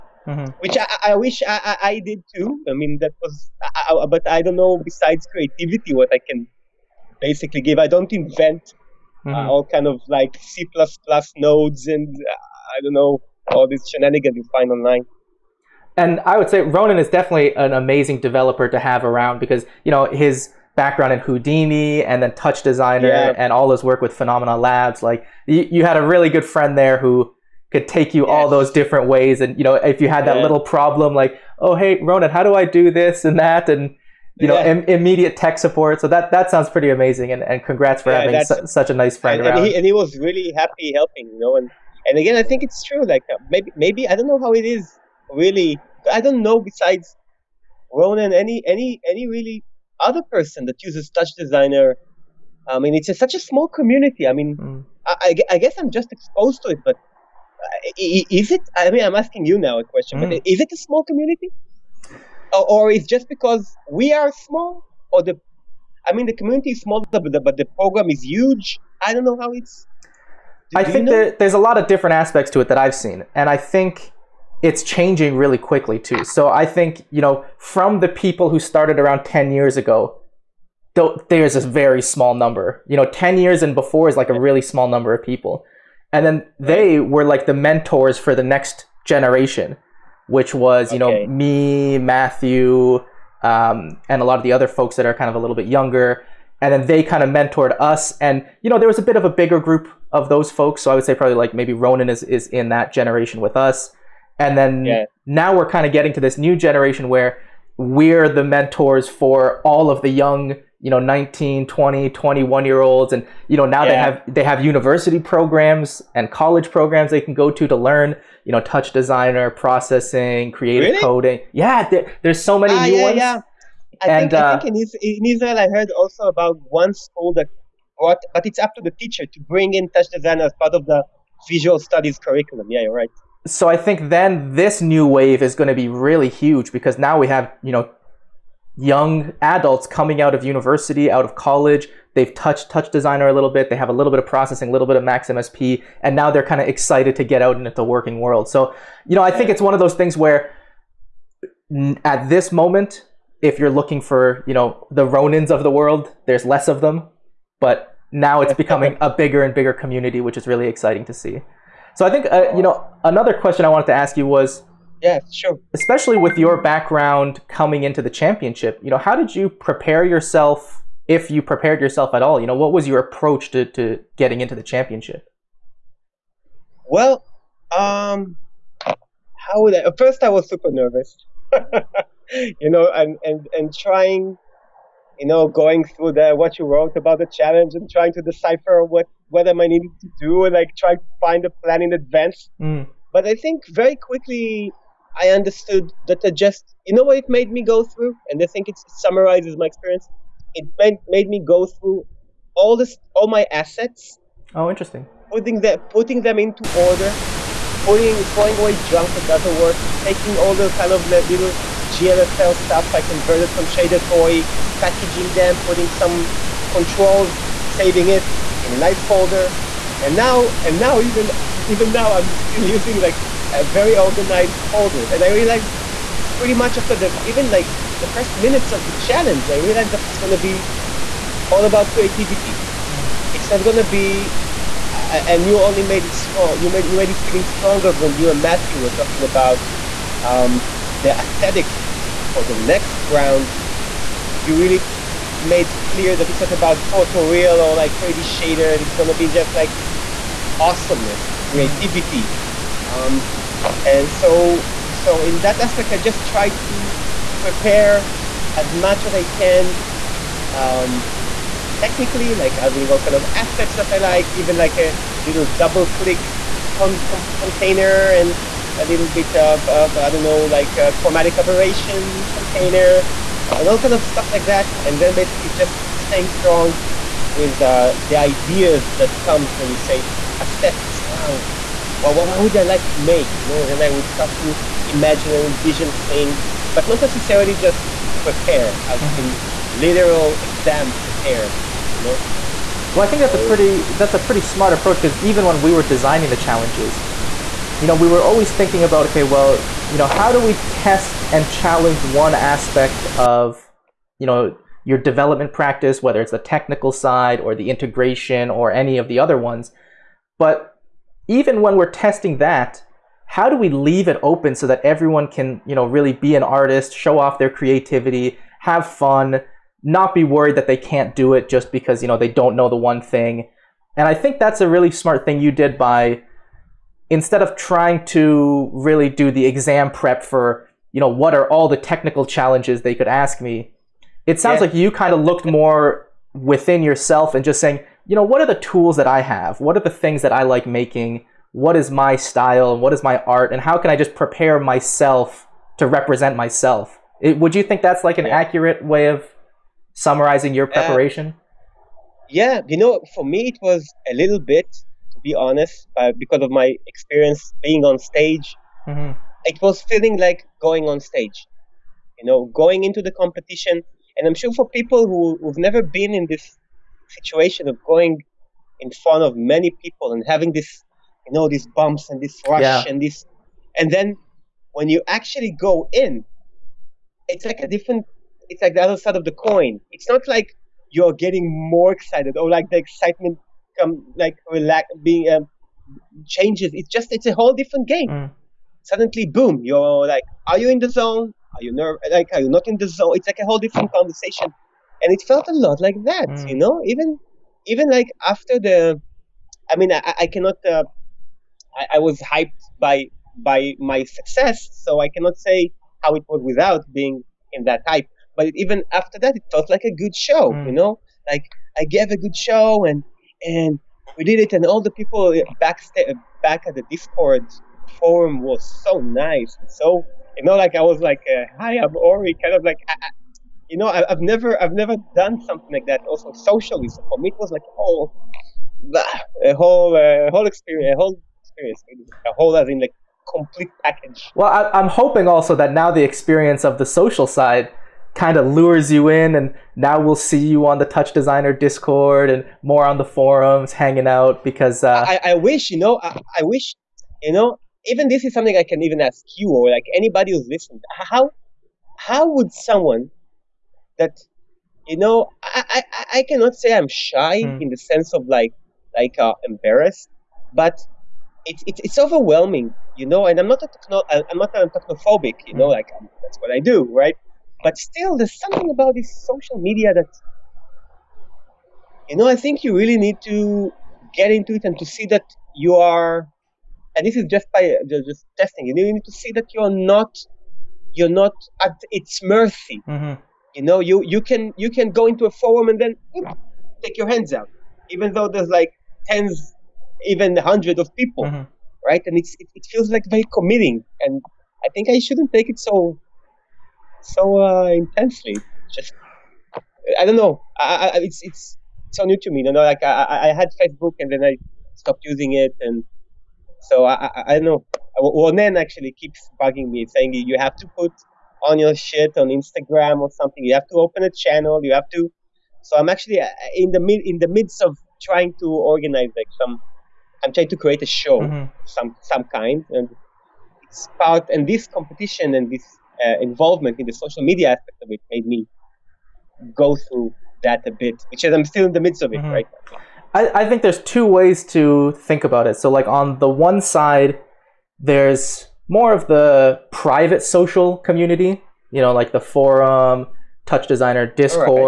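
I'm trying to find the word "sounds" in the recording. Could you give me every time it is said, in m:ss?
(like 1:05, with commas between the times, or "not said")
0:36, 5:34.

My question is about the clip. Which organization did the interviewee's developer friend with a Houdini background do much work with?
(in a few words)
Phenomena Labs.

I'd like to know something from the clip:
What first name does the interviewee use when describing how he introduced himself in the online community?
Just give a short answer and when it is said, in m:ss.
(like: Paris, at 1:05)
Ori, at 7:01.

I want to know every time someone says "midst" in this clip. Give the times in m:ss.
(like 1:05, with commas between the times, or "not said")
8:37, 8:51.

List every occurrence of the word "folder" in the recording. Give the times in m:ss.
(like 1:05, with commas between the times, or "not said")
3:39, 3:44.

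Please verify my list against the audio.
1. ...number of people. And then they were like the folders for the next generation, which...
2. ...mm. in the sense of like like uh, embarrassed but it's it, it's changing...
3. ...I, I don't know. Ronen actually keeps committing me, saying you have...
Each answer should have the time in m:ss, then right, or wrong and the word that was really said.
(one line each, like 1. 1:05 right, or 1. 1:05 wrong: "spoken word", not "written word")
1. 1:24 wrong: "mentors", not "folders"
2. 7:37 wrong: "overwhelming", not "changing"
3. 8:27 wrong: "bugging", not "committing".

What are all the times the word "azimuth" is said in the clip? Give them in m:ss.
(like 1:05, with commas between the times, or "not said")
not said.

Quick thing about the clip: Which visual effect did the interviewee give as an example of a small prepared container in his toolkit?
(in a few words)
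chromatic aberration.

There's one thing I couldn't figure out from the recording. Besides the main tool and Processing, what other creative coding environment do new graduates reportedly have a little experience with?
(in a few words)
Max MSP.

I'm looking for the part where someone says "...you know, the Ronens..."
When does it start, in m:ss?
2:34.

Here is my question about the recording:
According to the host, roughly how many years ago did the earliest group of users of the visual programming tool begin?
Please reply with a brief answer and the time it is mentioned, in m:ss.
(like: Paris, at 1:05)
10, at 1:19.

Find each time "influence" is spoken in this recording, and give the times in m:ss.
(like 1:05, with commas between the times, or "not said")
not said.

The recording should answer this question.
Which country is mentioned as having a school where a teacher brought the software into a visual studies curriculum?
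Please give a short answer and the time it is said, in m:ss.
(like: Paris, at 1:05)
Israel, at 2:05.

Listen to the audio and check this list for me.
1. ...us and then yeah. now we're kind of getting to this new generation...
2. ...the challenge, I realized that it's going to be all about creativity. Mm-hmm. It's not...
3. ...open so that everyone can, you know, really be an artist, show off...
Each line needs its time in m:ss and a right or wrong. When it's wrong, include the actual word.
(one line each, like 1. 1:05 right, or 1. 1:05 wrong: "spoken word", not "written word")
1. 1:43 right
2. 3:48 right
3. 5:14 right.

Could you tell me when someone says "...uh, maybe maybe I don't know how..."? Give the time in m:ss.
0:43.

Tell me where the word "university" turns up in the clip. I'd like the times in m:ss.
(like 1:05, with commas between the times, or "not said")
1:54, 2:20.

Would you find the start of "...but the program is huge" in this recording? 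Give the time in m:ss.
1:07.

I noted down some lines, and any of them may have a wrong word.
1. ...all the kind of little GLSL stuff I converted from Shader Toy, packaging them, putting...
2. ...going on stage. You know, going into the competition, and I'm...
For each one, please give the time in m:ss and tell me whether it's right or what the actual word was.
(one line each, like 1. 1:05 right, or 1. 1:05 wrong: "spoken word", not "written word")
1. 3:30 right
2. 6:00 right.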